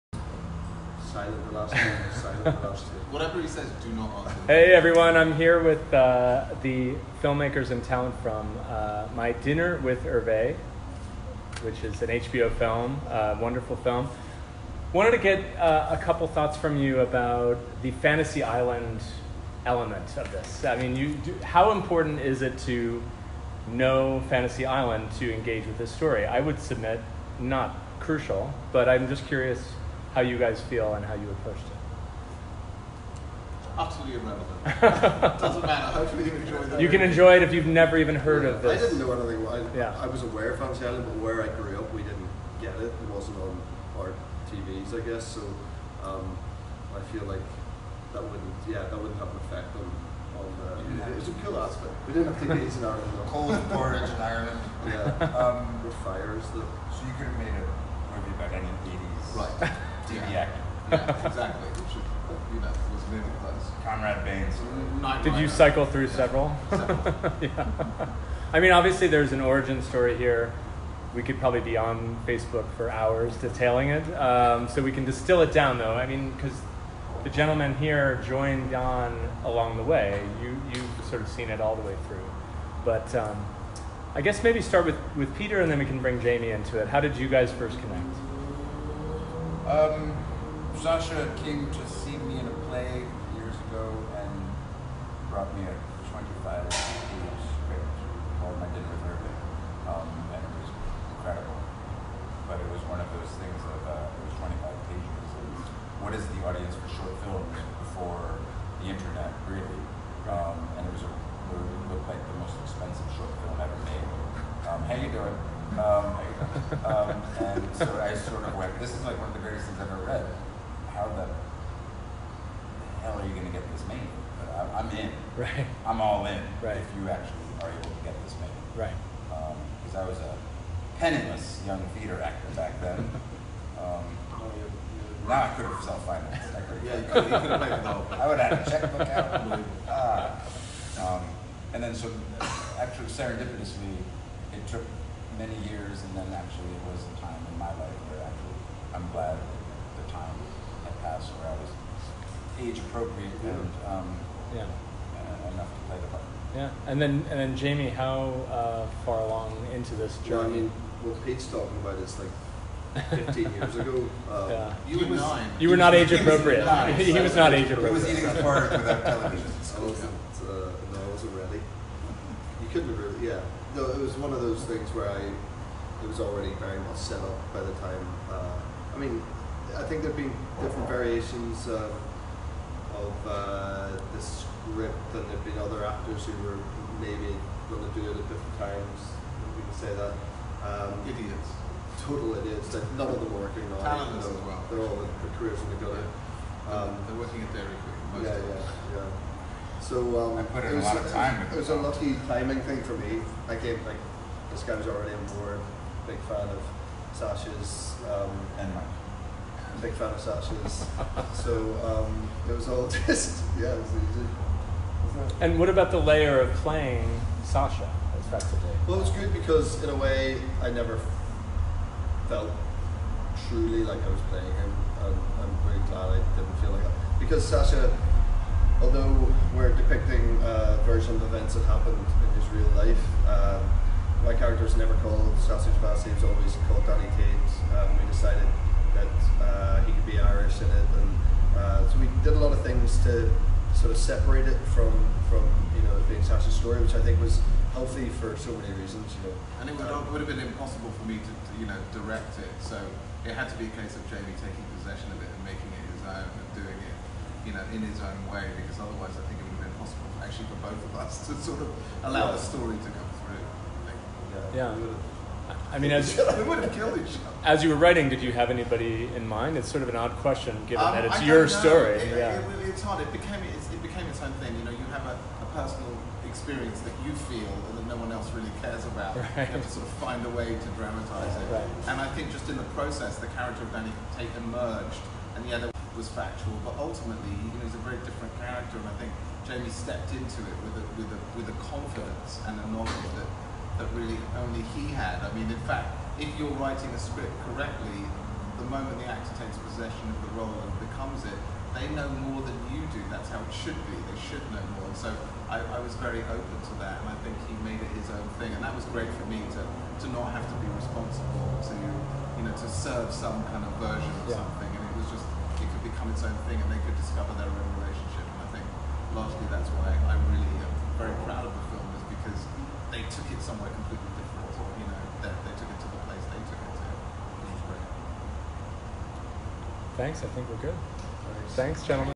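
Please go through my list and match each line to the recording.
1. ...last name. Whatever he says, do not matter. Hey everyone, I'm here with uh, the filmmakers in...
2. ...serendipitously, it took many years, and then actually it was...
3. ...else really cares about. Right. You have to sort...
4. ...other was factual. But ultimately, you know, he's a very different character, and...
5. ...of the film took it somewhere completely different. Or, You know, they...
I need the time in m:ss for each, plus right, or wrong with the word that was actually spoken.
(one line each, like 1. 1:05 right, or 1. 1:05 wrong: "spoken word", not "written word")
1. 0:02 wrong: "answer", not "matter"
2. 2:23 right
3. 4:38 right
4. 4:45 right
5. 5:21 right.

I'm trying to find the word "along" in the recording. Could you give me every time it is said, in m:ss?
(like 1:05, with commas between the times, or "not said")
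1:19, 2:39.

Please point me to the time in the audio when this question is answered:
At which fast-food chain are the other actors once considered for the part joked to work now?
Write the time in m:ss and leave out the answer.
3:17.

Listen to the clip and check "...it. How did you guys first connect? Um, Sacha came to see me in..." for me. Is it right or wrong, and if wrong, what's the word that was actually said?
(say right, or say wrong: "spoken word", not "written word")
right.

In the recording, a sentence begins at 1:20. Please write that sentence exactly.
You, you've sort of seen it all the way through.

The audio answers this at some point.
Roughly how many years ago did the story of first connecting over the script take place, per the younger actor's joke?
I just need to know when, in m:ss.
2:43.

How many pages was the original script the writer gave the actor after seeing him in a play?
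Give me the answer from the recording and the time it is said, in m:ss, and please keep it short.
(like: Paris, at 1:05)
25, at 1:36.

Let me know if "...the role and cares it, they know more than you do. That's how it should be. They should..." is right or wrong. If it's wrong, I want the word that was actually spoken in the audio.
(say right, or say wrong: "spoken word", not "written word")
wrong: "becomes", not "cares".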